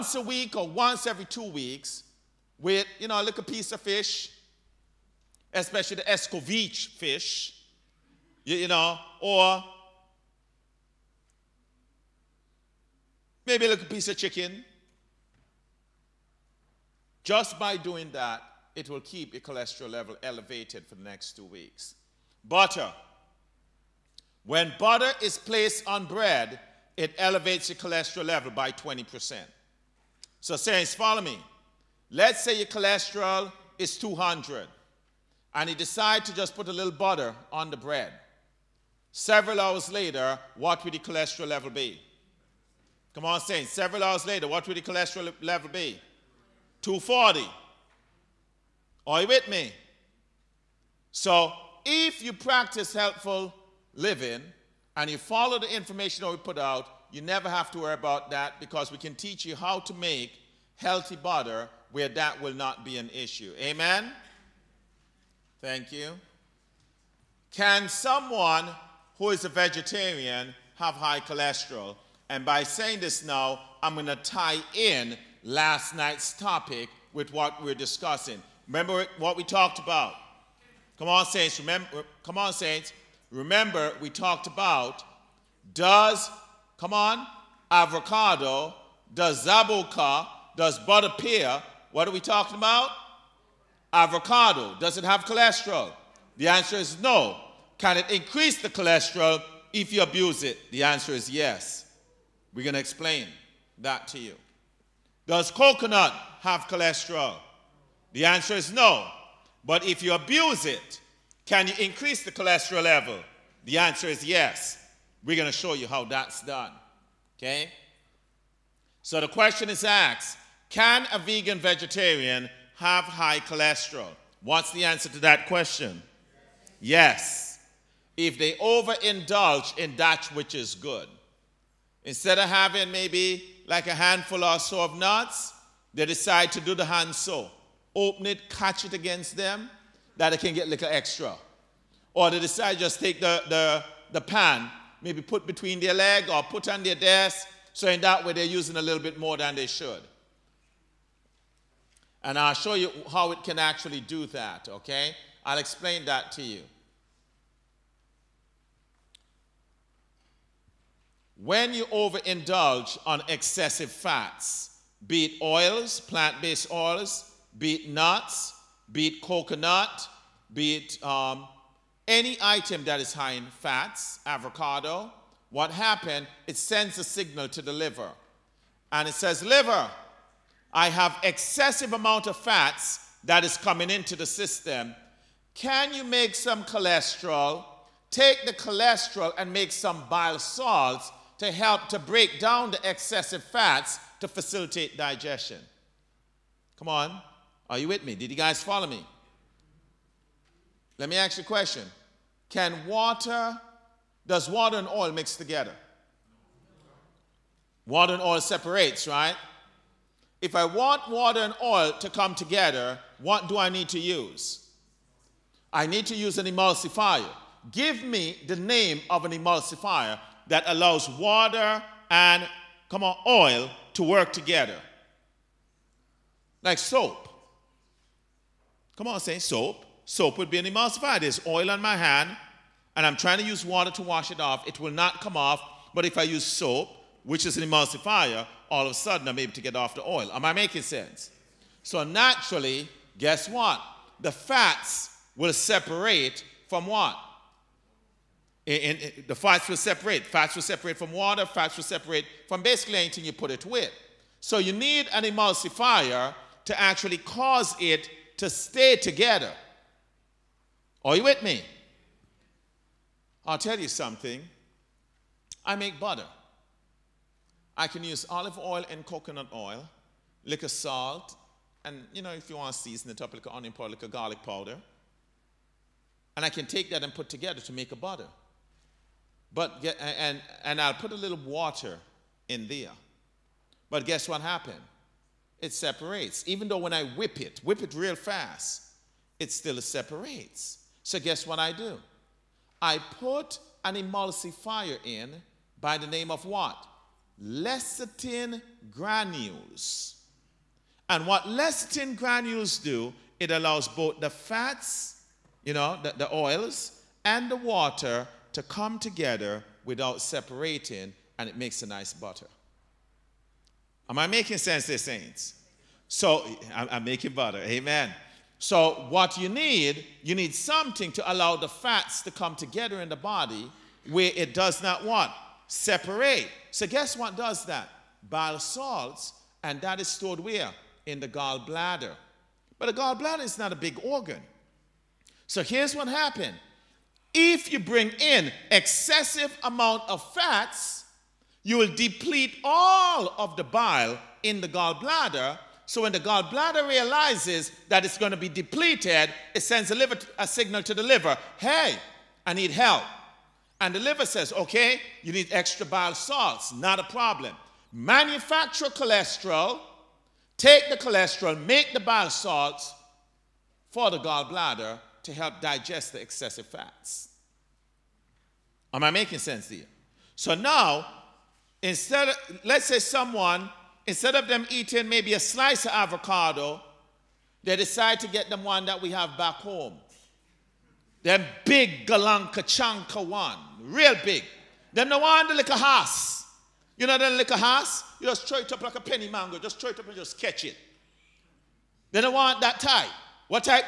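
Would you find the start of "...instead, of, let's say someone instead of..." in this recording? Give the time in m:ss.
6:11.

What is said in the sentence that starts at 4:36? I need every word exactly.
And I can take that and put together to make a butter.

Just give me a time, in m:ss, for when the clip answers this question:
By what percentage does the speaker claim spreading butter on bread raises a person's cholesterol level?
0:28.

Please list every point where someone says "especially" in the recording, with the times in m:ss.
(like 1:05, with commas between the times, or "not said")
0:05.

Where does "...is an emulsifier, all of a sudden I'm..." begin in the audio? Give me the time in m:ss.
3:57.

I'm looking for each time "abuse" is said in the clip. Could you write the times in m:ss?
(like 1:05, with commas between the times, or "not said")
1:40, 1:50.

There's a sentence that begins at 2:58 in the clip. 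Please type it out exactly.
And it says, liver, I have excessive amount of fats that is coming into the system.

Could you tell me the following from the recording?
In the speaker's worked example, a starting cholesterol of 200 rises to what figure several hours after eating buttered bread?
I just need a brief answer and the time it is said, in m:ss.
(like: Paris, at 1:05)
240, at 0:46.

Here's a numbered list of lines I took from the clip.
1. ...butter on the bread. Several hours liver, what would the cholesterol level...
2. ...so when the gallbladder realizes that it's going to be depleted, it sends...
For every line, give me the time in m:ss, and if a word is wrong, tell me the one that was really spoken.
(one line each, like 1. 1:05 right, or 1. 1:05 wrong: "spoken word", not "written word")
1. 0:36 wrong: "later", not "liver"
2. 5:45 right.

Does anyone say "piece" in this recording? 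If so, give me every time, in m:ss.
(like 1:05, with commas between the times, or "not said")
0:03, 0:13.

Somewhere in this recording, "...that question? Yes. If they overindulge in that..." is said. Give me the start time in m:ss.
2:05.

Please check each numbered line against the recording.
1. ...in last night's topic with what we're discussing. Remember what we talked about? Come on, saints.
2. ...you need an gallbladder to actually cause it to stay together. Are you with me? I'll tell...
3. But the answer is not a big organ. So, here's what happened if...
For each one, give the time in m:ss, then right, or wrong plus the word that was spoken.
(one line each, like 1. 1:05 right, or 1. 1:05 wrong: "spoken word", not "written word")
1. 1:14 right
2. 4:14 wrong: "emulsifier", not "gallbladder"
3. 5:32 wrong: "gallbladder", not "answer".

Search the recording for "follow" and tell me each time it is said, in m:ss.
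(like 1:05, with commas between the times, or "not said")
0:30, 0:55, 3:18.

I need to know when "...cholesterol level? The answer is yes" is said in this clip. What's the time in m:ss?
1:52.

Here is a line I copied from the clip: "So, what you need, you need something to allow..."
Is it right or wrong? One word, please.
right.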